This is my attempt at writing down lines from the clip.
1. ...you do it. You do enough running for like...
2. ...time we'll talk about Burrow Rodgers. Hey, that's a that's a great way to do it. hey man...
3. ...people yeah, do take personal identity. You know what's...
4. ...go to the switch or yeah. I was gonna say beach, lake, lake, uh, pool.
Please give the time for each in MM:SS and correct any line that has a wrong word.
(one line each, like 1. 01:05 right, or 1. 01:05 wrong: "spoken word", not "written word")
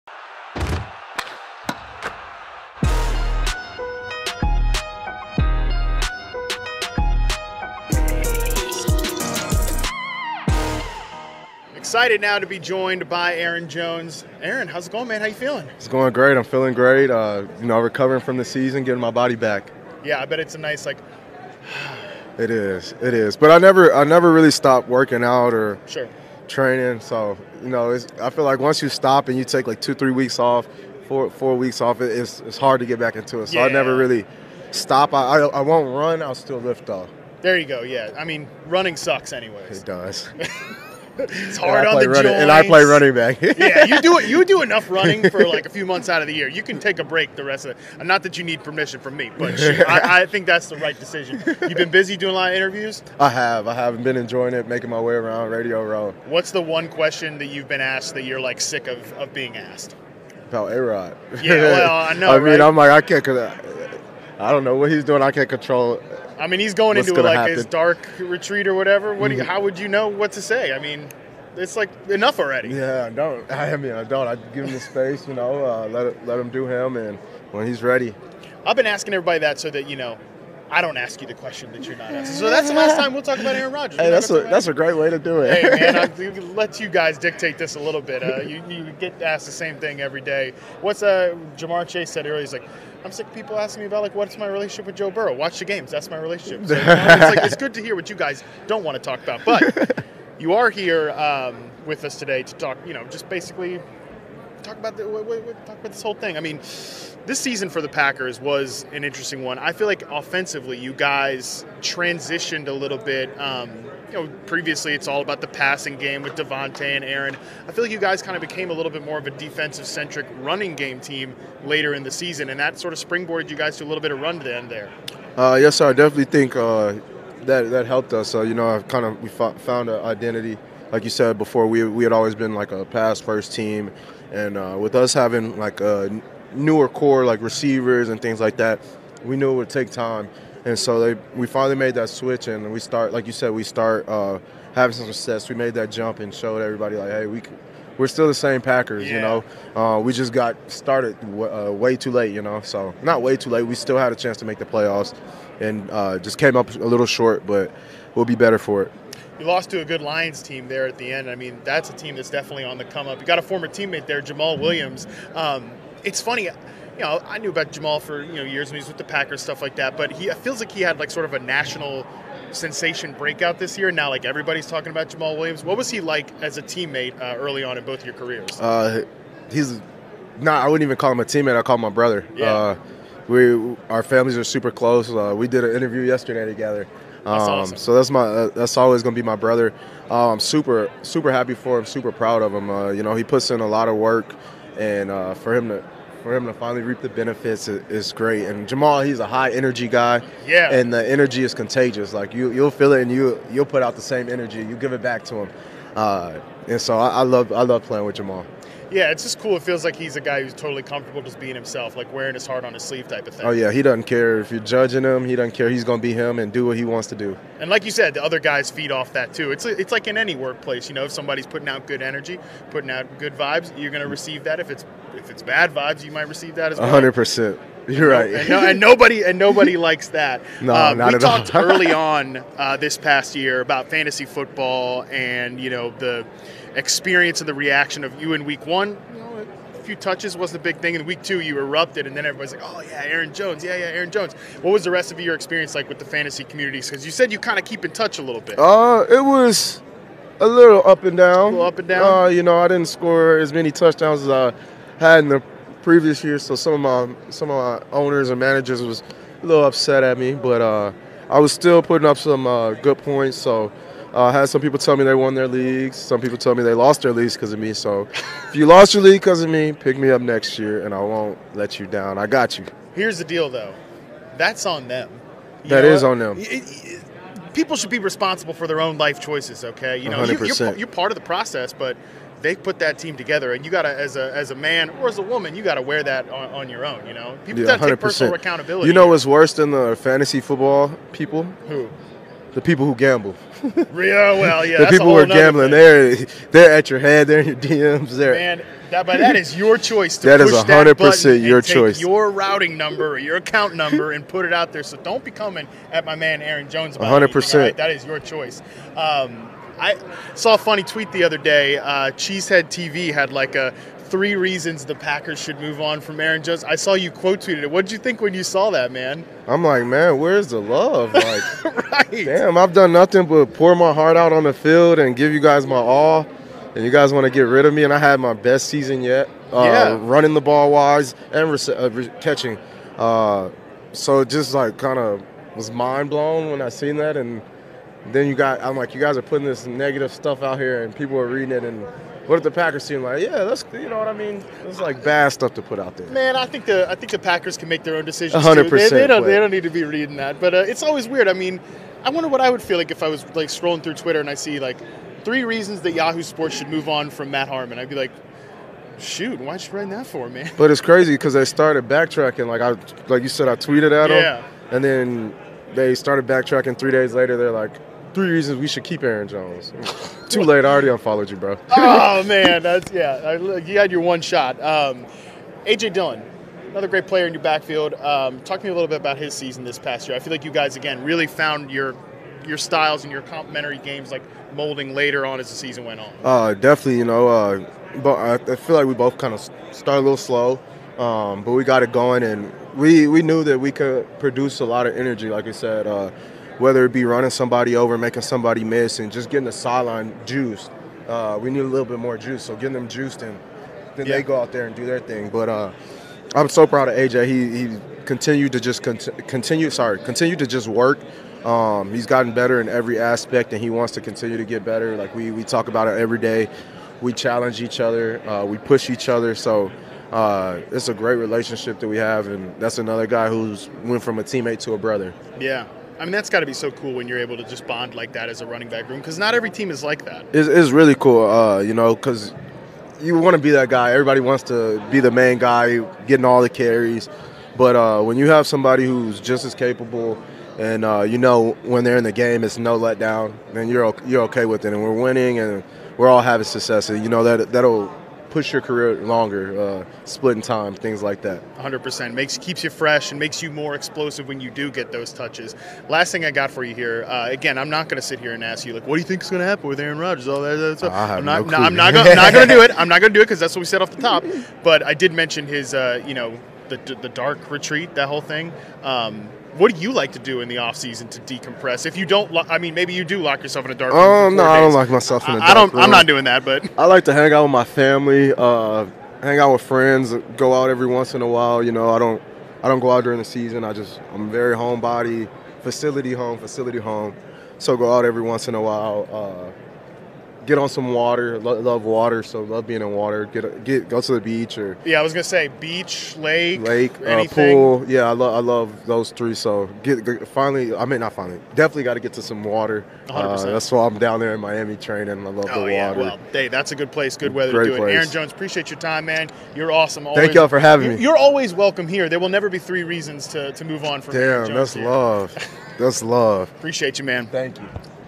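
1. 00:43 right
2. 01:22 wrong: "Aaron", not "Burrow"
3. 04:47 wrong: "accountability", not "identity"
4. 08:13 wrong: "beach", not "switch".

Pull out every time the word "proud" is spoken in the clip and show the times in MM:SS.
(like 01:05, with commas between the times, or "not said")
03:12, 06:46.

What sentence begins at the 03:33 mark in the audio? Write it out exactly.
Oh yeah, he doesn't care if you're judging him.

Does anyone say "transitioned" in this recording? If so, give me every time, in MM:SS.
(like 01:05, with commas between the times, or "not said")
01:51.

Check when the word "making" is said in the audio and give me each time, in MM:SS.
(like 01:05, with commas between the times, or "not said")
00:54, 06:37.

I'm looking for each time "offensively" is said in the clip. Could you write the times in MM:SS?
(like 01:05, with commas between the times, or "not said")
01:50.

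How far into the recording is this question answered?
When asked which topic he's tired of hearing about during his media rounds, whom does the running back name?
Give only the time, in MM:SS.
01:00.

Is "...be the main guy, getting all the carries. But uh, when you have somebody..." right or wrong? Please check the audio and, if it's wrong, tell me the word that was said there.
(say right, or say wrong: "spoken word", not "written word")
right.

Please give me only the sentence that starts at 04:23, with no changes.
So uh, I had some people tell me they won their leagues.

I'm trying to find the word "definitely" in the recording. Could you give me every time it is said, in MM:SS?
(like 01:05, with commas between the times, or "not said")
02:05, 02:42, 06:26, 08:21.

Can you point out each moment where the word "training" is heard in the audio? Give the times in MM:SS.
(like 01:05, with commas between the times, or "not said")
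00:26, 08:24.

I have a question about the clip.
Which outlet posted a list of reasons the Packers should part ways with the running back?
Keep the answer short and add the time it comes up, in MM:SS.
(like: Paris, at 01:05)
Cheesehead TV, at 05:12.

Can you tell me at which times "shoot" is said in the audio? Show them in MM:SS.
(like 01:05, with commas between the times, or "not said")
00:49, 05:58.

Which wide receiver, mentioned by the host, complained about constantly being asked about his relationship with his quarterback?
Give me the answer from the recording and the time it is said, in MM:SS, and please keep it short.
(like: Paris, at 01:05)
Ja'Marr Chase, at 01:31.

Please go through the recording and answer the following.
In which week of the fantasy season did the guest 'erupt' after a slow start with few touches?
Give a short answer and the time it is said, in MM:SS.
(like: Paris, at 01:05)
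Week 2, at 04:01.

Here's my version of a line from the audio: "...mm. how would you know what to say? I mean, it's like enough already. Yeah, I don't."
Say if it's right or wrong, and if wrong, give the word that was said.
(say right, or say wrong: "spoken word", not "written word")
right.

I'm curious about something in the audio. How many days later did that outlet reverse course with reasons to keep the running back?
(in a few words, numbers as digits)
3.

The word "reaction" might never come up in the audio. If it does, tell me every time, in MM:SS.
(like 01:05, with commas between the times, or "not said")
03:57.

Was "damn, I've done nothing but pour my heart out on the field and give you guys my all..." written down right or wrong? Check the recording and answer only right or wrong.
right.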